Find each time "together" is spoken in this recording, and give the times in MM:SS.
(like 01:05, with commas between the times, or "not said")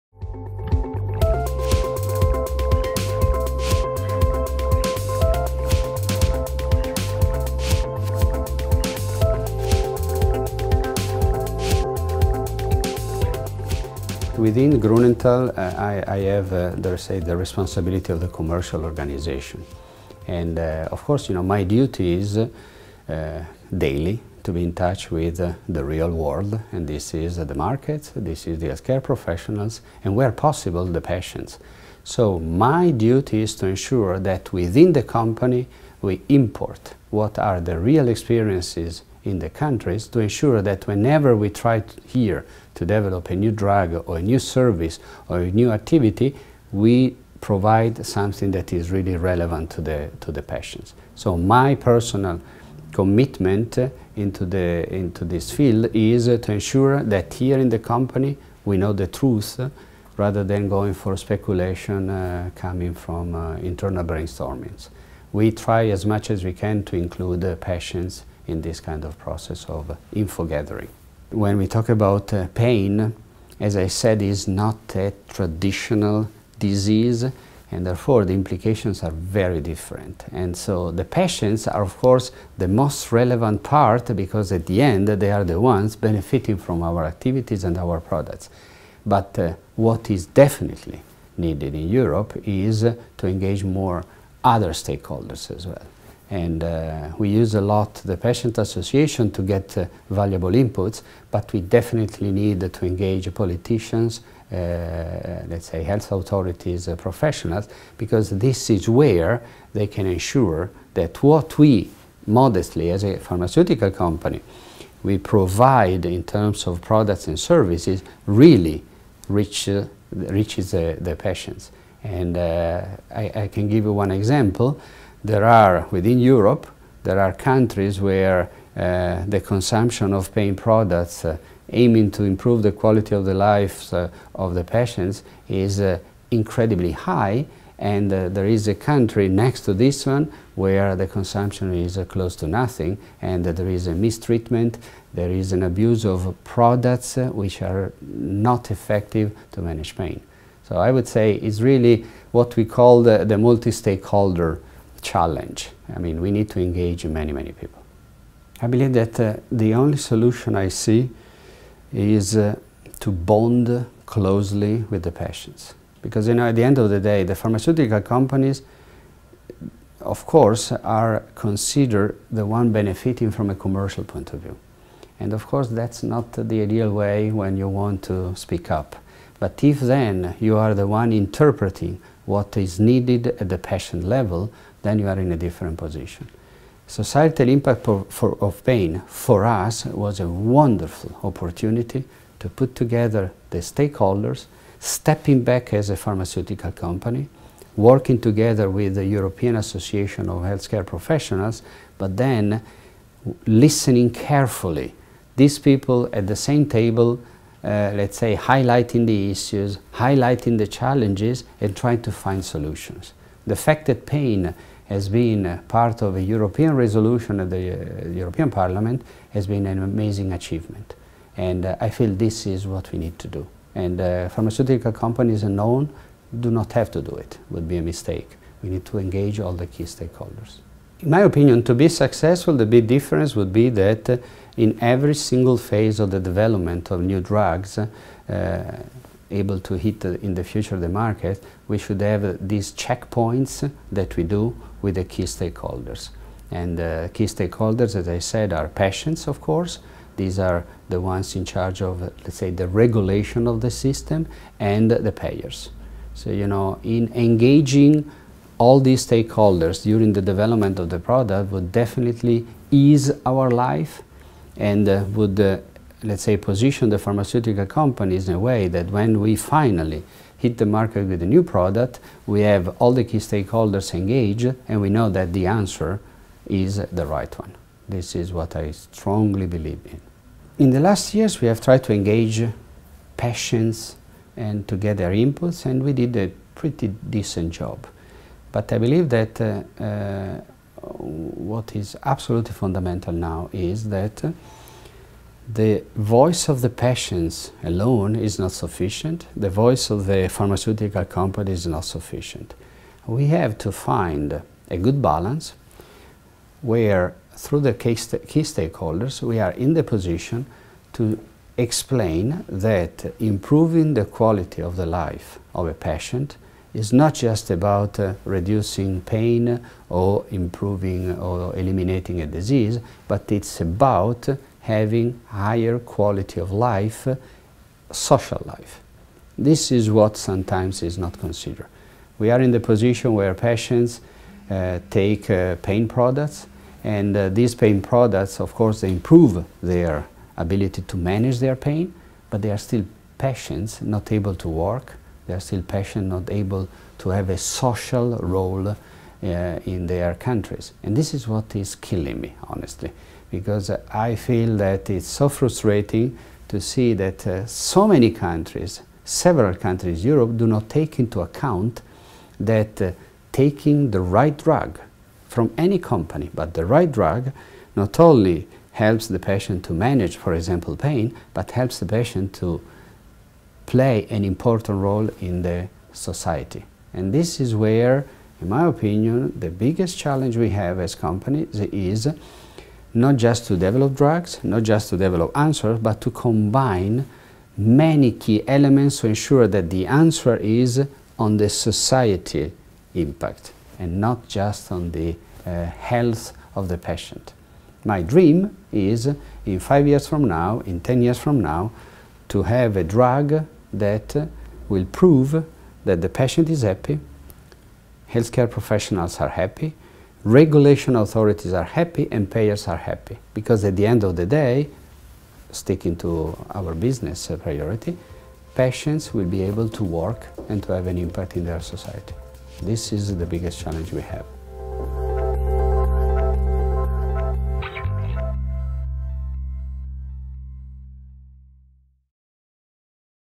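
03:12, 03:18.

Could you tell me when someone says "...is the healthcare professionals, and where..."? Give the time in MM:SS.
00:28.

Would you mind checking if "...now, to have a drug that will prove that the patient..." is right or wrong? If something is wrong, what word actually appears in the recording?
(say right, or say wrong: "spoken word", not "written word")
right.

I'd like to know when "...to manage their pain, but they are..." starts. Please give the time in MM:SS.
05:40.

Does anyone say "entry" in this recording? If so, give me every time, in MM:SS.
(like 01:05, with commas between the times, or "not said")
not said.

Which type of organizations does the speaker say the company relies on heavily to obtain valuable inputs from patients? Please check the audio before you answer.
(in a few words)
patient association.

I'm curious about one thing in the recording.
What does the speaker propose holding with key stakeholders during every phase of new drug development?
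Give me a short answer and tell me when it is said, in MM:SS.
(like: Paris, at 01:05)
checkpoints, at 04:02.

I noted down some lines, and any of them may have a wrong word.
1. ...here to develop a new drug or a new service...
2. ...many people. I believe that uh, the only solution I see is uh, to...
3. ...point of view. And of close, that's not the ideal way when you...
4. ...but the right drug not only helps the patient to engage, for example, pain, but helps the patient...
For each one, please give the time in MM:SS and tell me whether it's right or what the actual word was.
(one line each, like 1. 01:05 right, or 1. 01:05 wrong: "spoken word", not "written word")
1. 00:42 right
2. 02:37 right
3. 02:54 wrong: "course", not "close"
4. 06:06 wrong: "manage", not "engage".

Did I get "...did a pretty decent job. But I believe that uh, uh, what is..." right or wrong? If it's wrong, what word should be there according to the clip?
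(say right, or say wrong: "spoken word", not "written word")
right.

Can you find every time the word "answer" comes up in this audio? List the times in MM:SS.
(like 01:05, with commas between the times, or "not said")
04:35, 06:25, 06:29.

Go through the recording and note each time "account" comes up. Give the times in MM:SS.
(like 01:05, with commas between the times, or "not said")
06:01.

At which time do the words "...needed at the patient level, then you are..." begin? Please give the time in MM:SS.
03:02.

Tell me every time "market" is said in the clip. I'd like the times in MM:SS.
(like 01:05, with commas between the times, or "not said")
00:27, 04:00, 04:30.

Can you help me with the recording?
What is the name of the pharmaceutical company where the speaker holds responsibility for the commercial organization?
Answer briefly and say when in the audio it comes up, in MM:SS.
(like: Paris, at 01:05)
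Grunenthal, at 00:14.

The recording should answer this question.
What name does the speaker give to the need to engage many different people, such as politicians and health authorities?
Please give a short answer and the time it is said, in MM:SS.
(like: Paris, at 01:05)
multi-stakeholder challenge, at 02:33.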